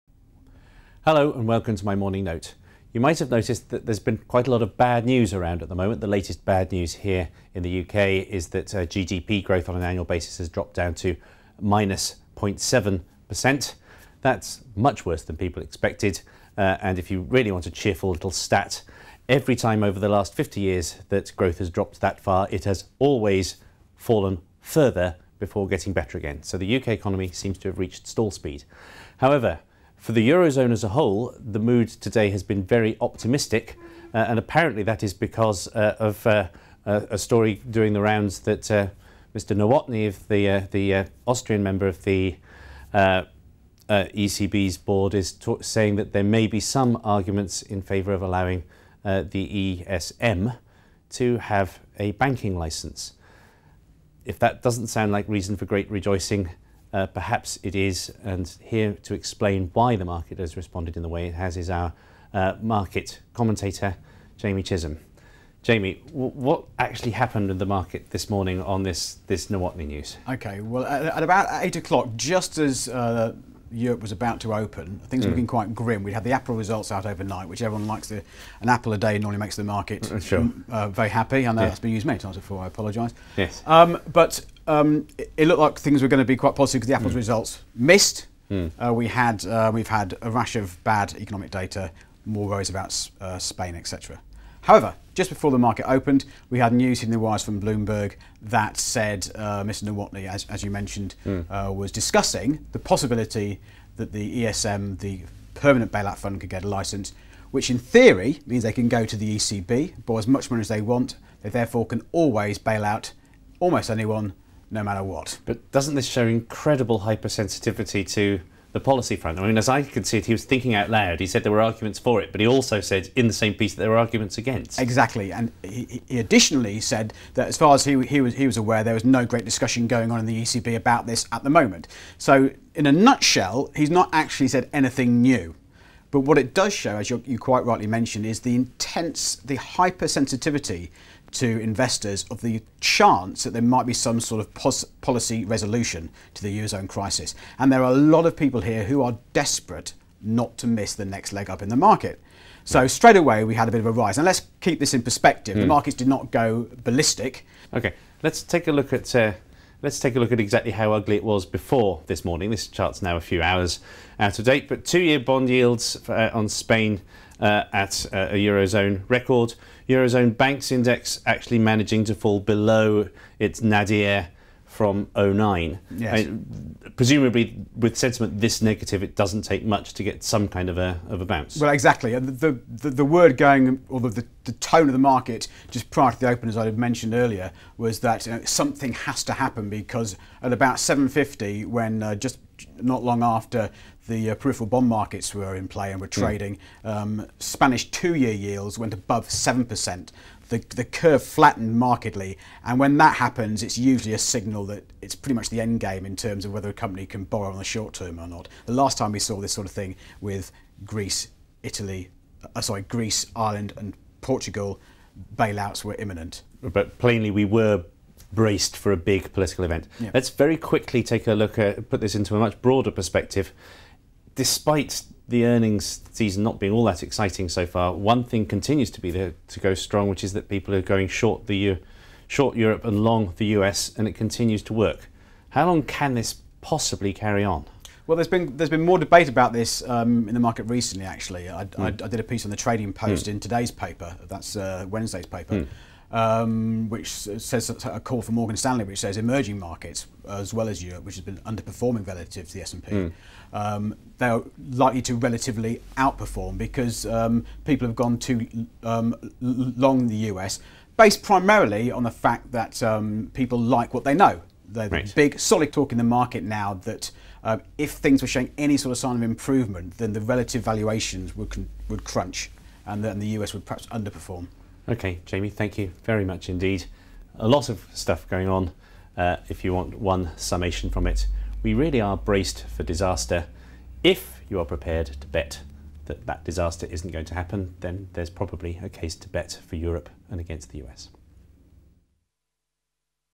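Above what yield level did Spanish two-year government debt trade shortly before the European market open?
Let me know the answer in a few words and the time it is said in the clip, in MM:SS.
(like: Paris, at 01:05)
7%, at 03:19.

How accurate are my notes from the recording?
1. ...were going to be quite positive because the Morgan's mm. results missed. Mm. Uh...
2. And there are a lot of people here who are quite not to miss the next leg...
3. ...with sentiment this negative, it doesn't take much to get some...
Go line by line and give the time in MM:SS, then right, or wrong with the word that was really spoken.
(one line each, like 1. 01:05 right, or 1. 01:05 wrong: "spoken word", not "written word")
1. 01:26 wrong: "Apple", not "Morgan"
2. 02:27 wrong: "desperate", not "quite"
3. 02:57 right.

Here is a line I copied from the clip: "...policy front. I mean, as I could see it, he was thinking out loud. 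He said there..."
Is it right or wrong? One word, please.
right.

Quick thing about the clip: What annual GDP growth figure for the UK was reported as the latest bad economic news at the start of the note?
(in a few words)
-0.7%.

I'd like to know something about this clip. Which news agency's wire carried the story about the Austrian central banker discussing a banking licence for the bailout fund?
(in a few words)
Bloomberg.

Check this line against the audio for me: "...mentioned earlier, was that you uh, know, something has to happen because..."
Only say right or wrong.
right.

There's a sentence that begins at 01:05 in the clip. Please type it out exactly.
Jamie, what actually happened in the market this morning on this this Nowotny news?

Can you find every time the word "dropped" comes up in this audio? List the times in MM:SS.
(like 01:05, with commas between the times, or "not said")
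00:10, 00:21.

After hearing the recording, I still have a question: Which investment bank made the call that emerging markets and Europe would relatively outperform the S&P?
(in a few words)
Morgan Stanley.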